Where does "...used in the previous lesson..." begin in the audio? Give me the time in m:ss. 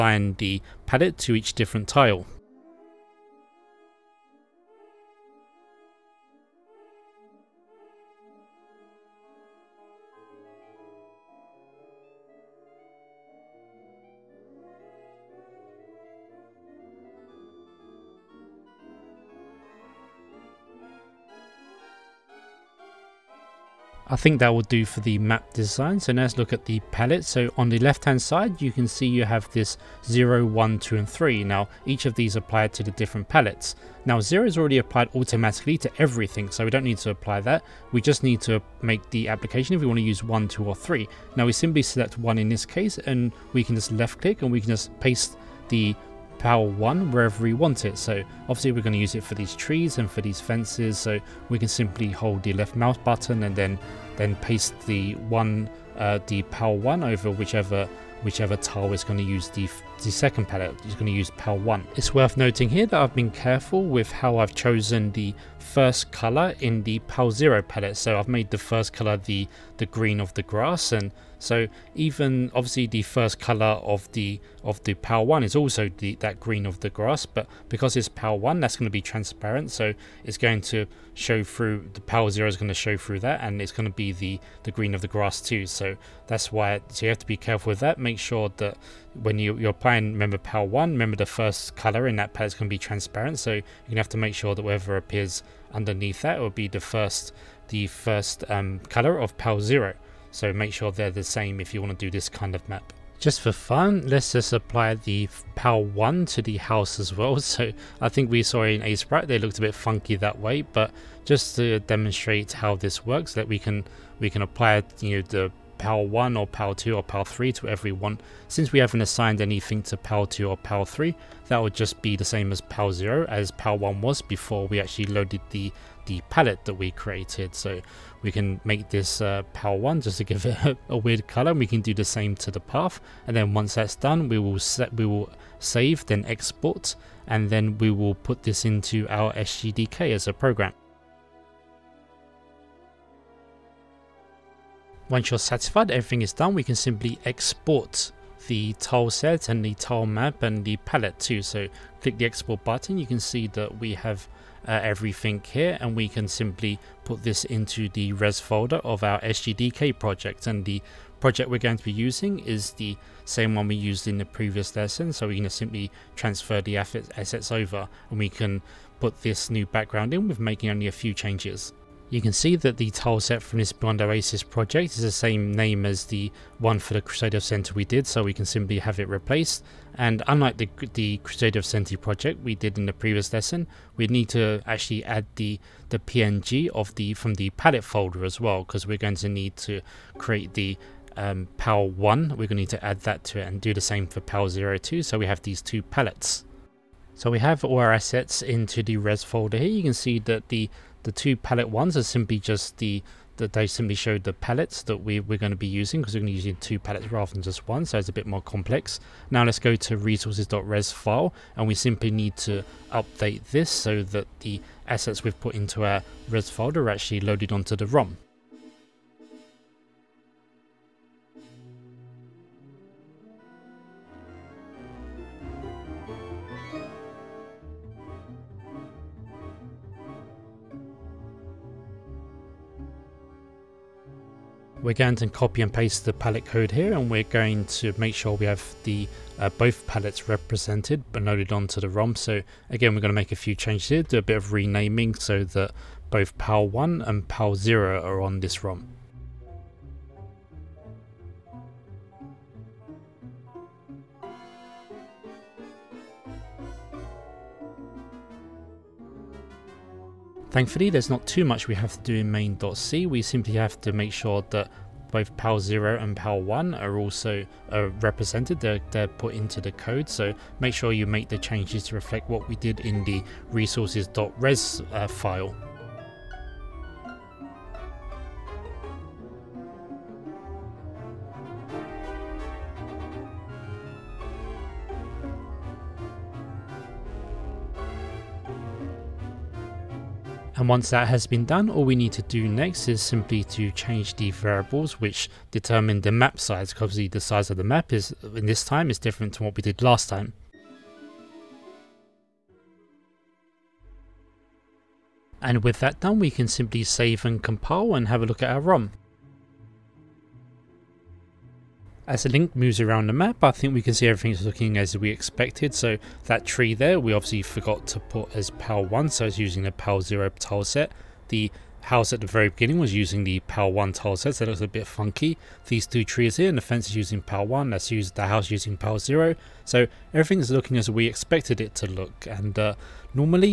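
2:43.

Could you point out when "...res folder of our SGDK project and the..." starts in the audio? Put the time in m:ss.
2:38.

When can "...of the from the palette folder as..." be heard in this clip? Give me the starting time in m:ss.
3:06.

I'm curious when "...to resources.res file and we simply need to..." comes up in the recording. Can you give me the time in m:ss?
3:29.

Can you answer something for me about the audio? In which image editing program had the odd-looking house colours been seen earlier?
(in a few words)
Aseprite.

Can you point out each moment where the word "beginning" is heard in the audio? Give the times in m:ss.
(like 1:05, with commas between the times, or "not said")
5:22.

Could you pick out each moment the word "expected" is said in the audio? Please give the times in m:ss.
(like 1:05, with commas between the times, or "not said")
5:15, 5:31.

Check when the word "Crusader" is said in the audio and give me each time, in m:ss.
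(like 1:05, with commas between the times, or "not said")
2:57, 3:01.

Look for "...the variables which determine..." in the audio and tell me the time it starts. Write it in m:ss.
4:54.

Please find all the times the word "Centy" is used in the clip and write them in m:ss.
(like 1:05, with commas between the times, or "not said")
2:57, 3:01.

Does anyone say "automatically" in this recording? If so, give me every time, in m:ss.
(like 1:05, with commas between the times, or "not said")
0:35.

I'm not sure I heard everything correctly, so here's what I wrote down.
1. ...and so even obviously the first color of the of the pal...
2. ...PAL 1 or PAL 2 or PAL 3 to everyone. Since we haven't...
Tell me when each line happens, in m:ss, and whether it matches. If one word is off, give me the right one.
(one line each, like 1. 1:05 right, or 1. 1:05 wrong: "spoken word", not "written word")
1. 1:10 right
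2. 1:55 right.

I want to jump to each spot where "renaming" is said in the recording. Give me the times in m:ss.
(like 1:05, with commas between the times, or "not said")
4:04.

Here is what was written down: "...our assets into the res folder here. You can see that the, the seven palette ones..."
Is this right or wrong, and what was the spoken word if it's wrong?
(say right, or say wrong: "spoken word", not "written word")
wrong: "two", not "seven".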